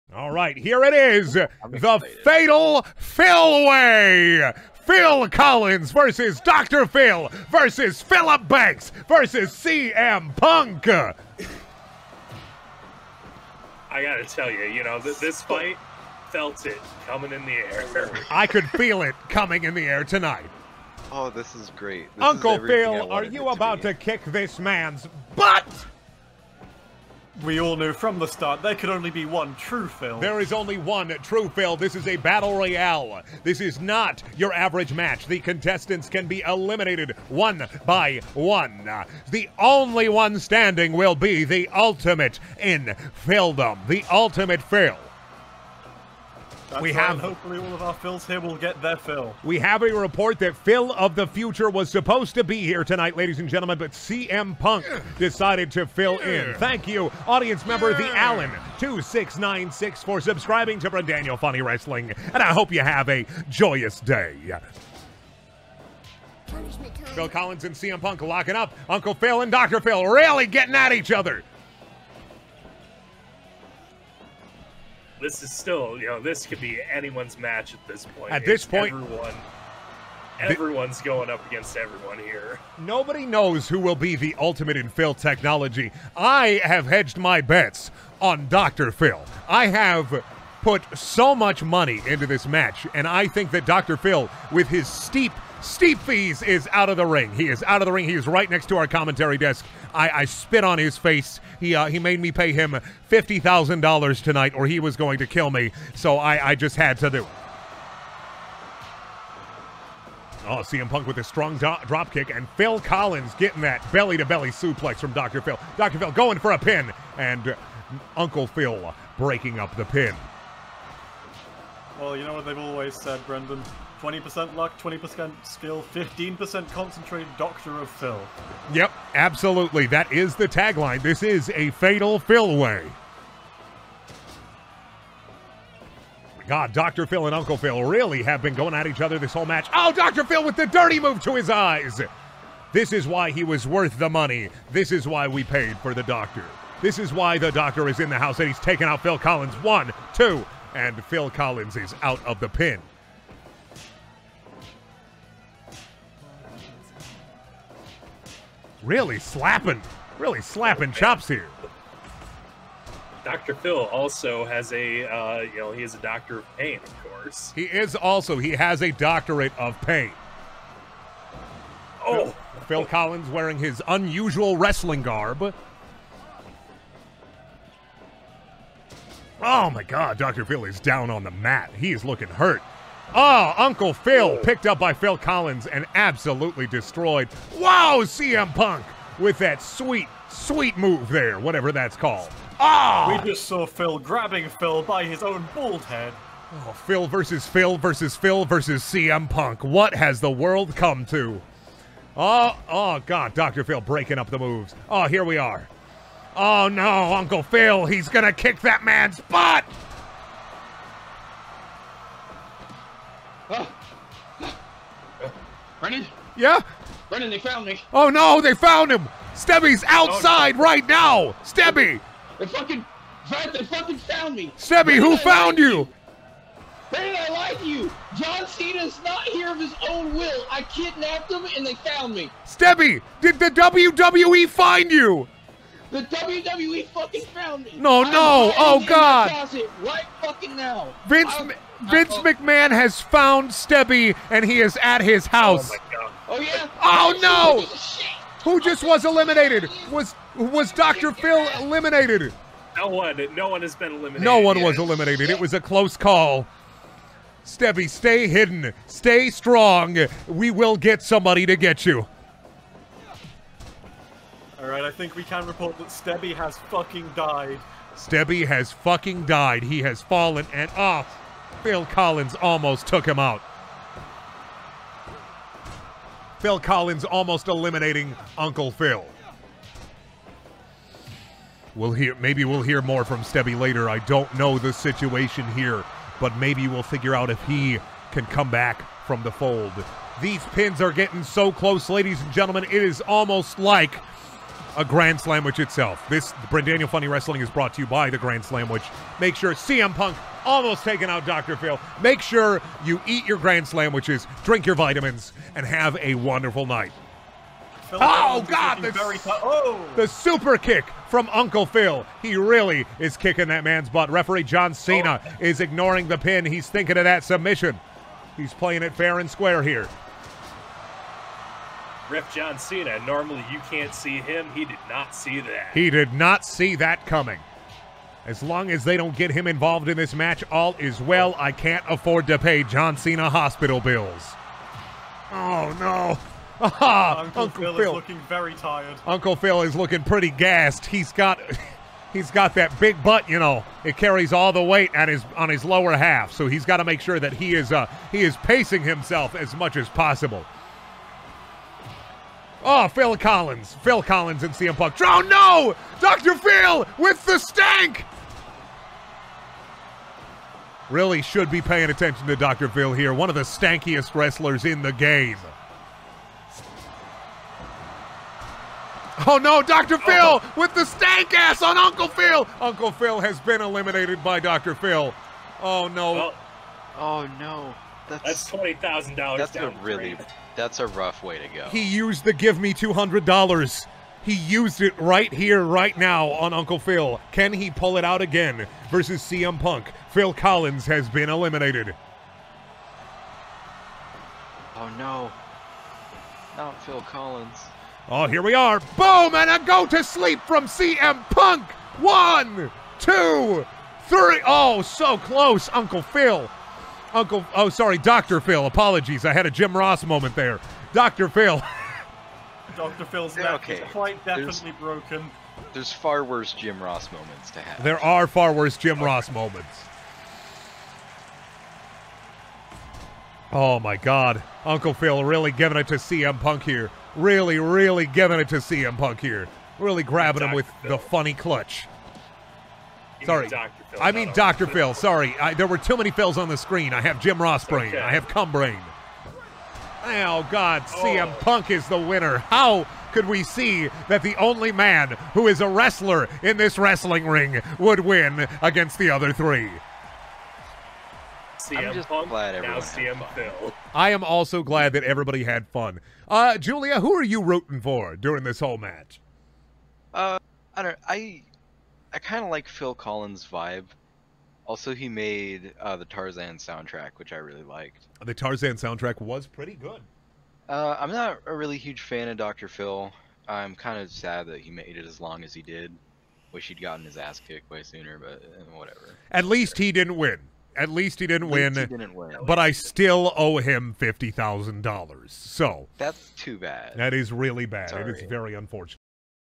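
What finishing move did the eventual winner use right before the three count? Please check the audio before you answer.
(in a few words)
Go to sleep.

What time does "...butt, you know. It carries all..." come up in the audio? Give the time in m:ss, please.
5:43.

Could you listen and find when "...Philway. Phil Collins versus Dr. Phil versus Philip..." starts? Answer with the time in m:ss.
0:02.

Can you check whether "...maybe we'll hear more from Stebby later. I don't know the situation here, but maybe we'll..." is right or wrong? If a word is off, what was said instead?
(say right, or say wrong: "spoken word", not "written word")
right.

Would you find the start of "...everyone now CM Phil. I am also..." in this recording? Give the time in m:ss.
7:32.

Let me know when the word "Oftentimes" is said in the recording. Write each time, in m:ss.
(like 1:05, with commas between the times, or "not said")
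not said.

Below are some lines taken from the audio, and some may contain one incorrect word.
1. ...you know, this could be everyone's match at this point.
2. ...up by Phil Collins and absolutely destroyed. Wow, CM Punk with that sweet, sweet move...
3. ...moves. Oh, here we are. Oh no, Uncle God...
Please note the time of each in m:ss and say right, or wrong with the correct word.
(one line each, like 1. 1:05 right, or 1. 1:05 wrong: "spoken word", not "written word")
1. 1:16 wrong: "anyone", not "everyone"
2. 3:04 right
3. 3:24 wrong: "Phil", not "God".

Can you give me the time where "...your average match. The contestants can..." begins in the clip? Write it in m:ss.
0:34.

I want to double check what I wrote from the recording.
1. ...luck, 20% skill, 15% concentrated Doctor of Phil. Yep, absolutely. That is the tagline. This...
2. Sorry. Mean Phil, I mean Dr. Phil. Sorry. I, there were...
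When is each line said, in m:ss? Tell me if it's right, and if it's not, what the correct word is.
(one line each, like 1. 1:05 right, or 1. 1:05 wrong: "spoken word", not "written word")
1. 2:04 right
2. 7:13 right.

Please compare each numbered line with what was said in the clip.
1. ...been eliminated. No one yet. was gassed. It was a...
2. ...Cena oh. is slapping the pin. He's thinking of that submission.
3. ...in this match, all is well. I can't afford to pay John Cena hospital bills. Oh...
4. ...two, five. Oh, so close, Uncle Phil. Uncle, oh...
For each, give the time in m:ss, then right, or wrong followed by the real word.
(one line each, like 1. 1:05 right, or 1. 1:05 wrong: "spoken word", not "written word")
1. 4:13 wrong: "eliminated", not "gassed"
2. 5:14 wrong: "ignoring", not "slapping"
3. 5:29 right
4. 6:42 wrong: "three", not "five".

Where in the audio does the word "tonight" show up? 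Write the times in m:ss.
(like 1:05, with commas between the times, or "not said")
0:20, 0:52, 1:44.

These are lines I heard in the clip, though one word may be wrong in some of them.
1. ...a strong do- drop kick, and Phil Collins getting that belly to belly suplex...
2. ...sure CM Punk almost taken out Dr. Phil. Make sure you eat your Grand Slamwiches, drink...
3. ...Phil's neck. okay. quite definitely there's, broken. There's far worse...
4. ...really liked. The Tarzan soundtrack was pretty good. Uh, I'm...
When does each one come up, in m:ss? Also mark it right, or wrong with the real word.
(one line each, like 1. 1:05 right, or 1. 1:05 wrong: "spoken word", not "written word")
1. 1:51 right
2. 4:59 right
3. 6:53 right
4. 7:47 right.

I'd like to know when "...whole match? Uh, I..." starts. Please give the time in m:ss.
7:38.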